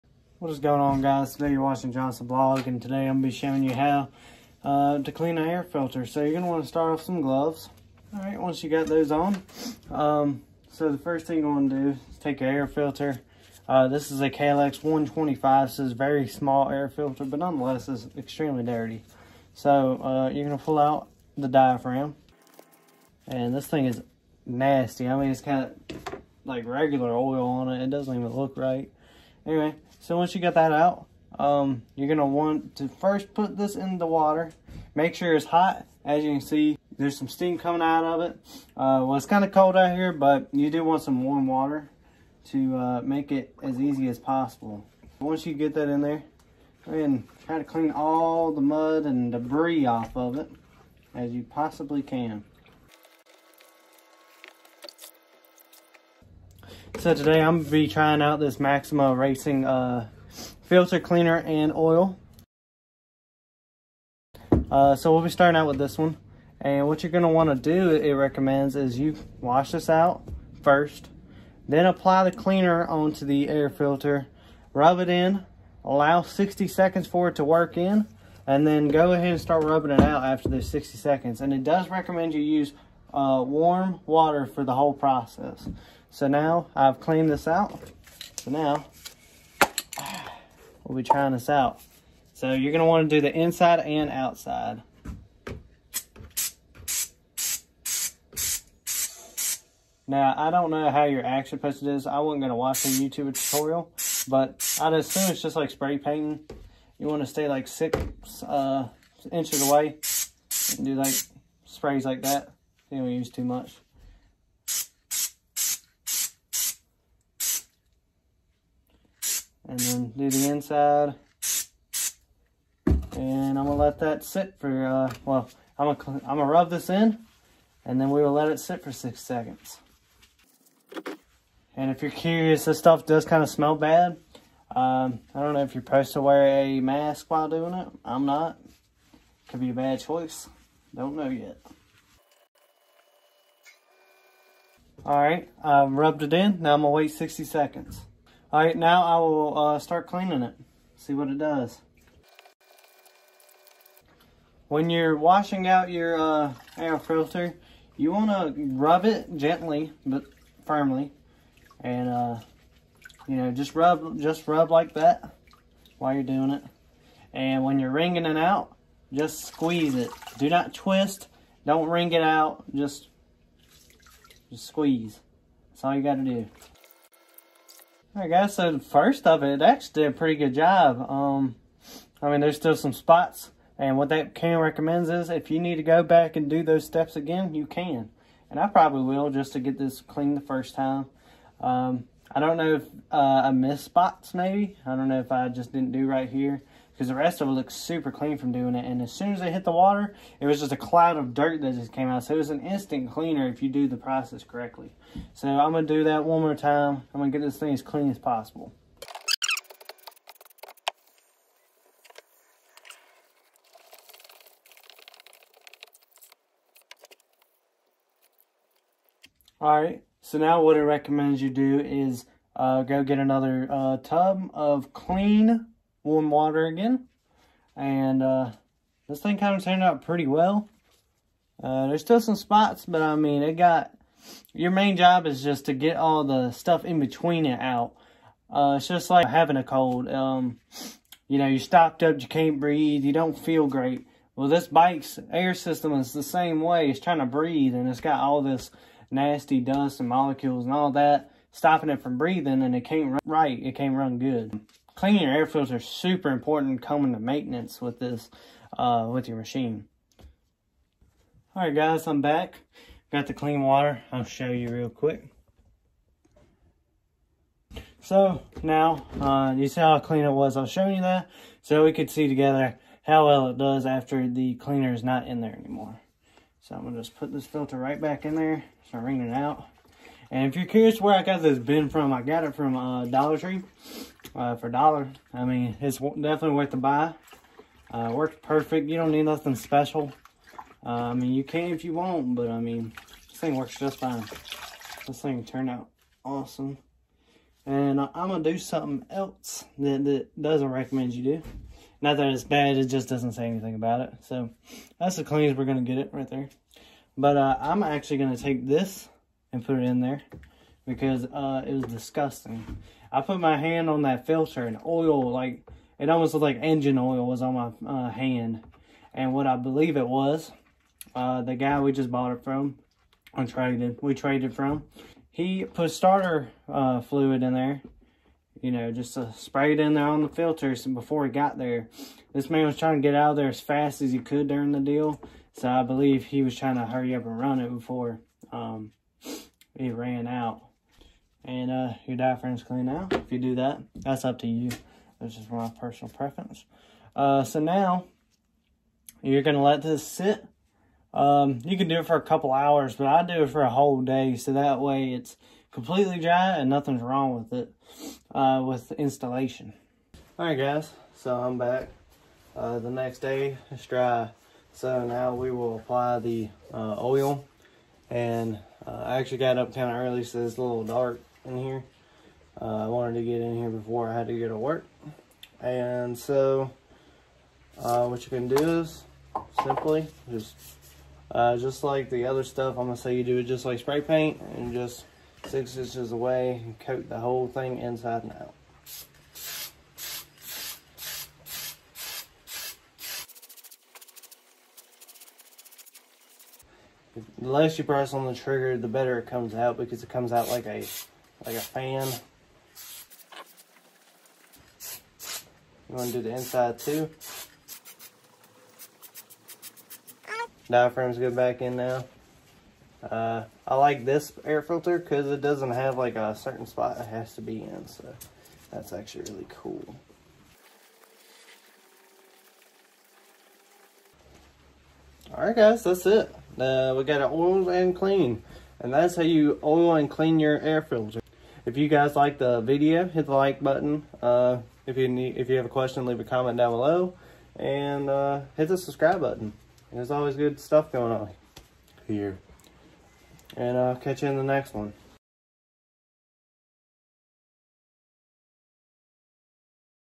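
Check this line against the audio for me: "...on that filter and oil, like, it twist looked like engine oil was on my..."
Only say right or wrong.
wrong.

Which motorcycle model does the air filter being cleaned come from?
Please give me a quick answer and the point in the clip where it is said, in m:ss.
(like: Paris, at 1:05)
KLX 125, at 0:14.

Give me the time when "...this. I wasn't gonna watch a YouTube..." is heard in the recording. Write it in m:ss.
1:41.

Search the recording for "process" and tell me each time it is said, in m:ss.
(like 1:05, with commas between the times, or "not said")
1:24, 3:23.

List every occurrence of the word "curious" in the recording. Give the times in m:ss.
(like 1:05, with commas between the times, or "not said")
2:12, 4:40.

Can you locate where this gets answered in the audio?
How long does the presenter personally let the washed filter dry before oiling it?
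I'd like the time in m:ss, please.
5:53.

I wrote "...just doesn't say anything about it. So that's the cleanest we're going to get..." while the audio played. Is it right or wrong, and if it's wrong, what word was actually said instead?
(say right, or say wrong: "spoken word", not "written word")
right.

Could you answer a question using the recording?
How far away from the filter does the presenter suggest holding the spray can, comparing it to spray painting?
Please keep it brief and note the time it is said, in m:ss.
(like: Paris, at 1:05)
6 inches, at 1:47.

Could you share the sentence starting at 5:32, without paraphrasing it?
This man was trying to get out of there as fast as he could during the deal.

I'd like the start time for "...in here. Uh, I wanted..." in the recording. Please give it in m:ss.
6:11.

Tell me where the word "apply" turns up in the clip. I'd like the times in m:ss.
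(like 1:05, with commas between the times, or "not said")
1:11, 6:05.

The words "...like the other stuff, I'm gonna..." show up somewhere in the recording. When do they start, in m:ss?
6:21.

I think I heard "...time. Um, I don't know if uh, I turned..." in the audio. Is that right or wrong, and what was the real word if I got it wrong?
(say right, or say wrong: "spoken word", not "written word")
wrong: "missed", not "turned".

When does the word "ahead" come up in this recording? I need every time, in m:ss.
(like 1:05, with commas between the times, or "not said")
0:46, 1:19.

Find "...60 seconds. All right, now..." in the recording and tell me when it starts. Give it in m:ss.
2:27.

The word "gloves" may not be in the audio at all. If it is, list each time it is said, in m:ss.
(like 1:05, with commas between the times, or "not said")
0:07.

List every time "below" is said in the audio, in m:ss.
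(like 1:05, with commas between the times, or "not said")
7:16.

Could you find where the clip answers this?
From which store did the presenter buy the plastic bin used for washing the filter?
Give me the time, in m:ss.
4:43.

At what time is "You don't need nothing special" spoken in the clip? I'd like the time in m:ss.
4:48.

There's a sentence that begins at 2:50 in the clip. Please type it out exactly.
Do not twist, don't wring it out, just just squeeze.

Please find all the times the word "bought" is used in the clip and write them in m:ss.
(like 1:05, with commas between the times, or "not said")
5:22.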